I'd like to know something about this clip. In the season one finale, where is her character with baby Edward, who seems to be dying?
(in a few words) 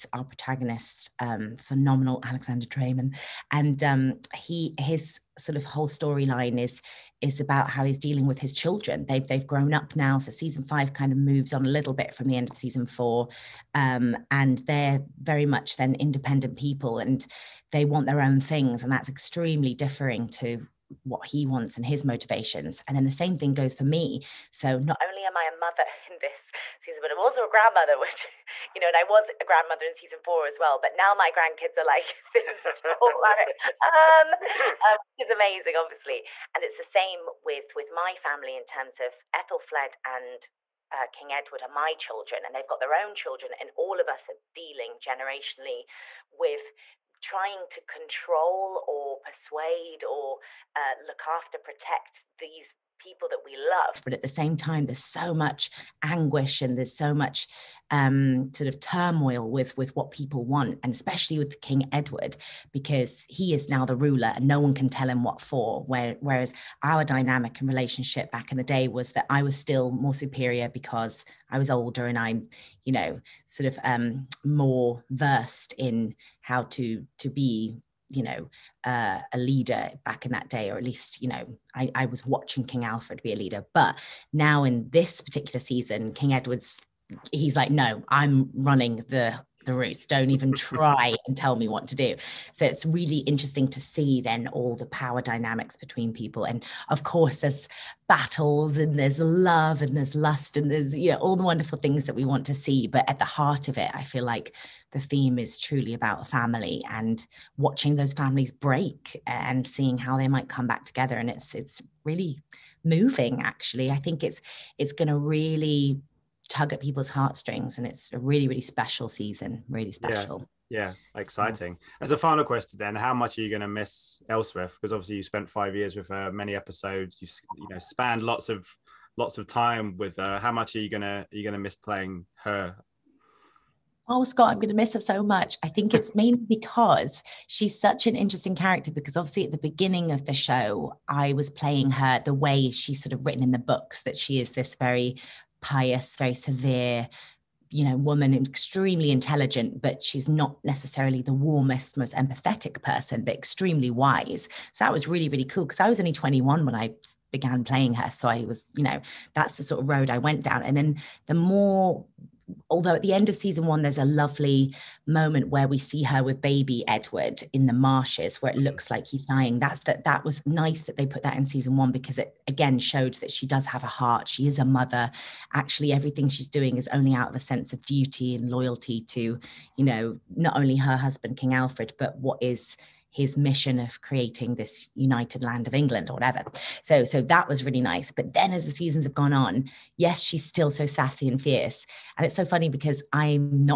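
The marshes.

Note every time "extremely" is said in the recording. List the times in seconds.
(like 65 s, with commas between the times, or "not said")
19 s, 148 s, 153 s.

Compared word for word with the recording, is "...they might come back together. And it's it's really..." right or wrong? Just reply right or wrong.
right.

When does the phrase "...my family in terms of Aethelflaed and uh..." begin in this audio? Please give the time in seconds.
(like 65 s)
37 s.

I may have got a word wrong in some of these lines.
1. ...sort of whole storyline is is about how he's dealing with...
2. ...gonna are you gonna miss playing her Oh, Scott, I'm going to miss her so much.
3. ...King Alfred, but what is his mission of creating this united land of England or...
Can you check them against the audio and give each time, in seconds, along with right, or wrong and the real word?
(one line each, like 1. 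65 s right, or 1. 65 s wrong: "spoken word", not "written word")
1. 5 s right
2. 130 s right
3. 181 s right.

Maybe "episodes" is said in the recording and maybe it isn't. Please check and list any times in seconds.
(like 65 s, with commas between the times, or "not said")
126 s.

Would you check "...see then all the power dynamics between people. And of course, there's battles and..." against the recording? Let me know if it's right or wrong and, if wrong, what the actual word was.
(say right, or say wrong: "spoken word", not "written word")
right.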